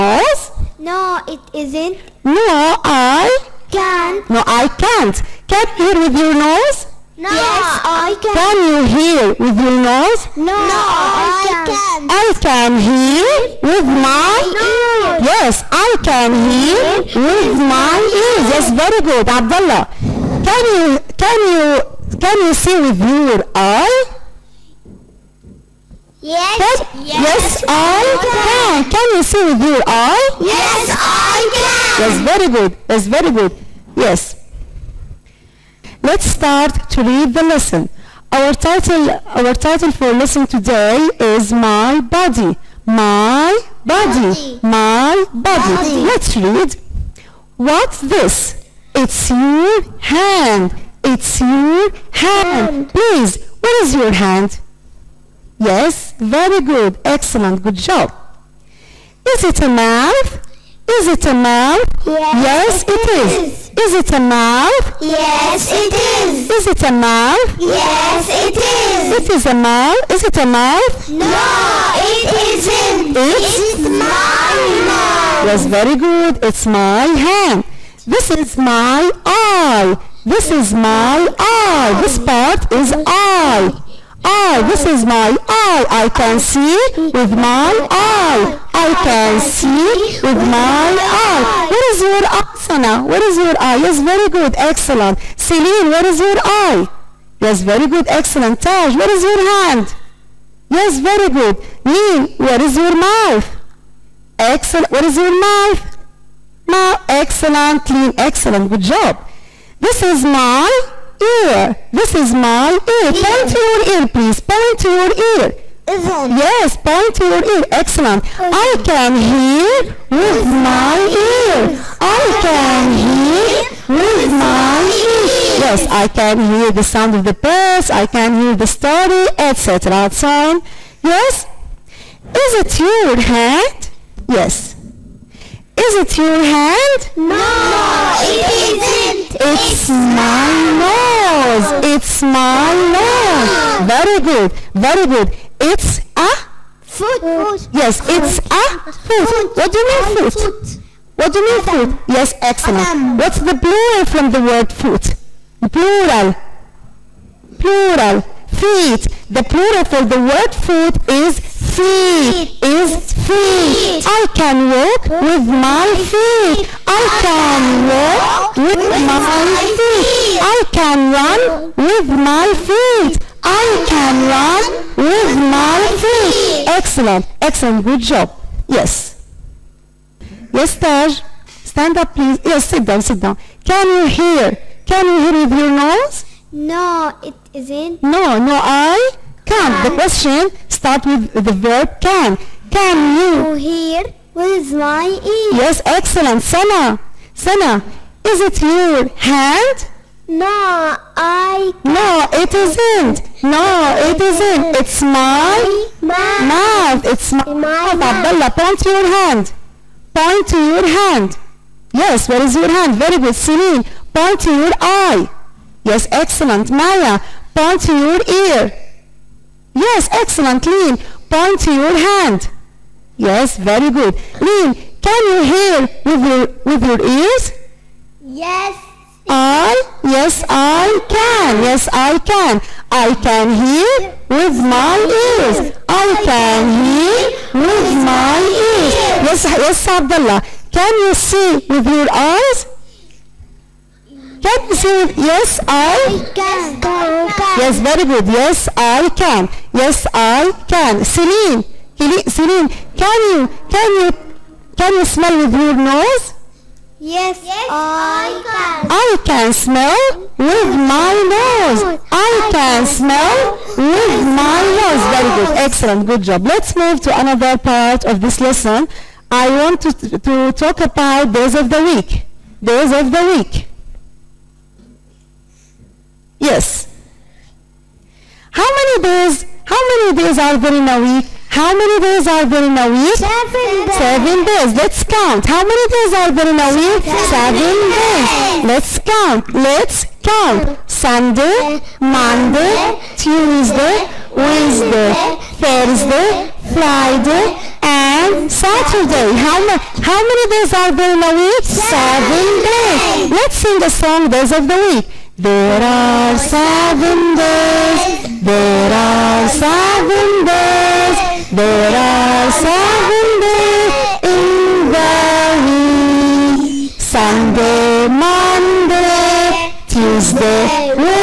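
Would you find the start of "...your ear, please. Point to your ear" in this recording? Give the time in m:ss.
1:53.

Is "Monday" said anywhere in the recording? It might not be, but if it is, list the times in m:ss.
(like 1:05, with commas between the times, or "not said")
4:52, 5:18.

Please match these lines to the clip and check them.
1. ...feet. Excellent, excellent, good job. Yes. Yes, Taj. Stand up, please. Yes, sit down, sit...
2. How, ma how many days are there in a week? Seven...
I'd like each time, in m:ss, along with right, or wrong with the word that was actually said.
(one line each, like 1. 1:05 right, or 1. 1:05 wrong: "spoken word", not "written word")
1. 2:55 right
2. 4:59 right.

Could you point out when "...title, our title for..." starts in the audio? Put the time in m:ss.
0:38.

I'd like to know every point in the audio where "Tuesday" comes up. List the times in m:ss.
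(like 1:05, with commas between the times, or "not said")
4:53, 5:19.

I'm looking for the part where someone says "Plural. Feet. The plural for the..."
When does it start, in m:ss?
2:37.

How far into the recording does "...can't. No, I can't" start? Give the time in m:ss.
0:03.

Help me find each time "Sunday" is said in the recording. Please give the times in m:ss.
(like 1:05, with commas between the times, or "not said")
4:50, 5:16.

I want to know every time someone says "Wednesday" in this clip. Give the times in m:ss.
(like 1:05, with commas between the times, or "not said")
4:54.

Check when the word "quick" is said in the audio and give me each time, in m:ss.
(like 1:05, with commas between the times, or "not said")
not said.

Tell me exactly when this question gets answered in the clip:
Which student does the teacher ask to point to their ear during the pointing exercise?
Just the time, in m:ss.
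3:36.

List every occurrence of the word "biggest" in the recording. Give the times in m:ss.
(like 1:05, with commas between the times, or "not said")
not said.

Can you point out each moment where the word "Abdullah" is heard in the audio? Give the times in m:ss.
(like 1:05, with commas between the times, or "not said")
0:19, 3:28, 3:59.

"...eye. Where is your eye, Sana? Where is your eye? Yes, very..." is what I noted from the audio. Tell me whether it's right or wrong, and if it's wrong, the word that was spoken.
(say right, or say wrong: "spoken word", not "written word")
right.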